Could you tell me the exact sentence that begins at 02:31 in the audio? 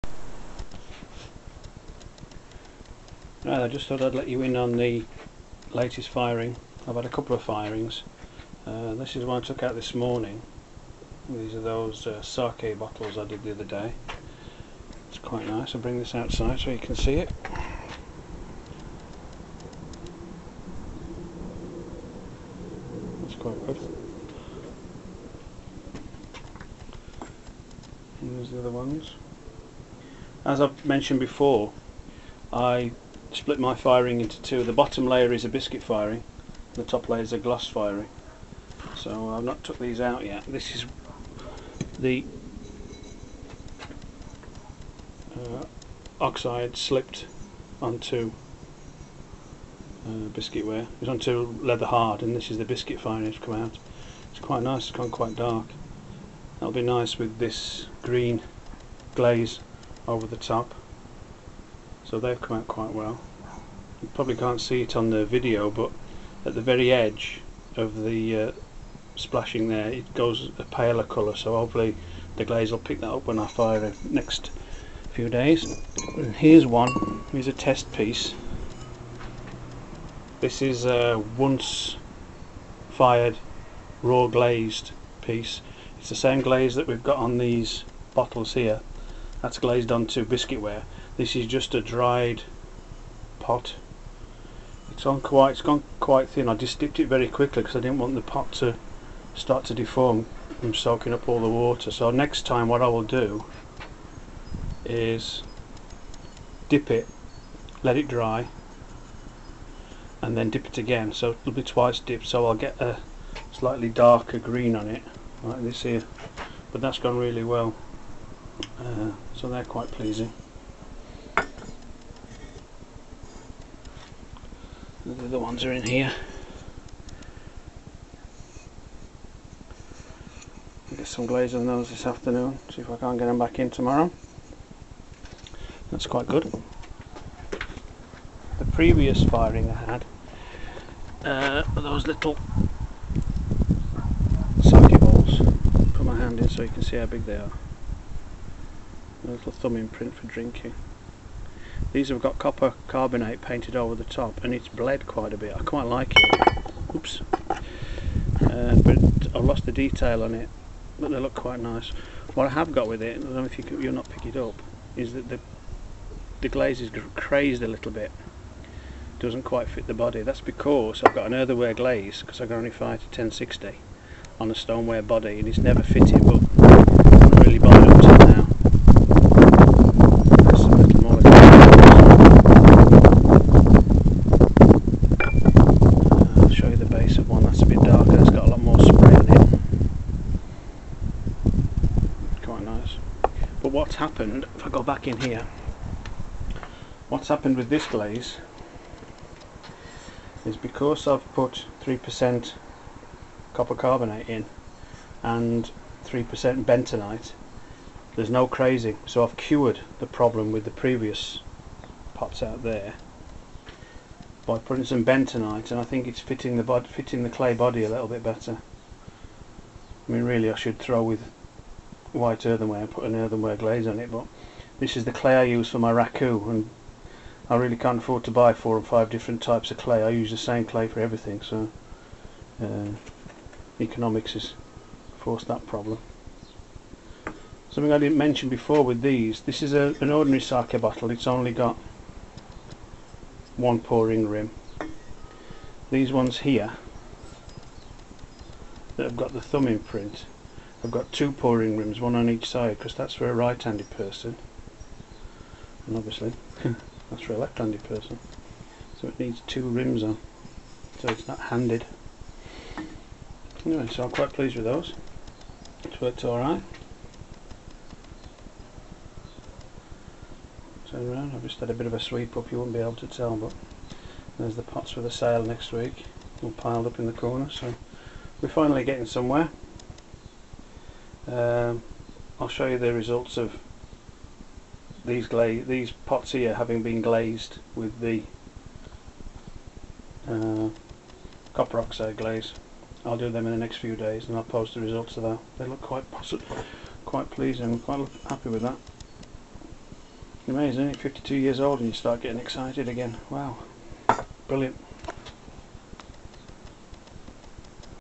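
These have got copper carbonate painted over the top and it's bled quite a bit.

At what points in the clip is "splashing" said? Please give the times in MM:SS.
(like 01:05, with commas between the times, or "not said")
01:09.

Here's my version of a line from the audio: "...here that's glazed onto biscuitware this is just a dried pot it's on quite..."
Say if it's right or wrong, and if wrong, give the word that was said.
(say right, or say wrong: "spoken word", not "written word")
right.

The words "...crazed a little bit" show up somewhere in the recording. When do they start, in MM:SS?
02:47.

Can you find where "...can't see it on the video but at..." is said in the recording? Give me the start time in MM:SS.
01:04.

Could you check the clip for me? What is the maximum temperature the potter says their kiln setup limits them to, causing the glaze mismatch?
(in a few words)
1060.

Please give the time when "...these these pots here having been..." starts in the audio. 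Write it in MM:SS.
04:45.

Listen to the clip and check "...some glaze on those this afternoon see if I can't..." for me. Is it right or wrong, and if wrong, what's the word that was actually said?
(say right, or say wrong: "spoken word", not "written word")
right.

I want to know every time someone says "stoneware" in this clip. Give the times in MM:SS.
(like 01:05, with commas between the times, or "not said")
02:54.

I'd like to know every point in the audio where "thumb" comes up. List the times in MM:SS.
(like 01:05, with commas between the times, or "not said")
02:29, 04:09.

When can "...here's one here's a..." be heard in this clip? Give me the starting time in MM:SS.
01:16.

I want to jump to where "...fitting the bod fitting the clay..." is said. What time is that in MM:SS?
03:36.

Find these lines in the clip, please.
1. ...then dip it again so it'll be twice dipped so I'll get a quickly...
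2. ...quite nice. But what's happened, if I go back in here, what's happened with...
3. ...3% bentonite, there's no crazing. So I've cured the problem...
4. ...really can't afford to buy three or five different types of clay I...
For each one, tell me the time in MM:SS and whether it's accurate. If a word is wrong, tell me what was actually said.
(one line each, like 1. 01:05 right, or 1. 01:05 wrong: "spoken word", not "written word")
1. 01:50 wrong: "slightly", not "quickly"
2. 03:12 right
3. 03:26 right
4. 03:47 wrong: "four", not "three".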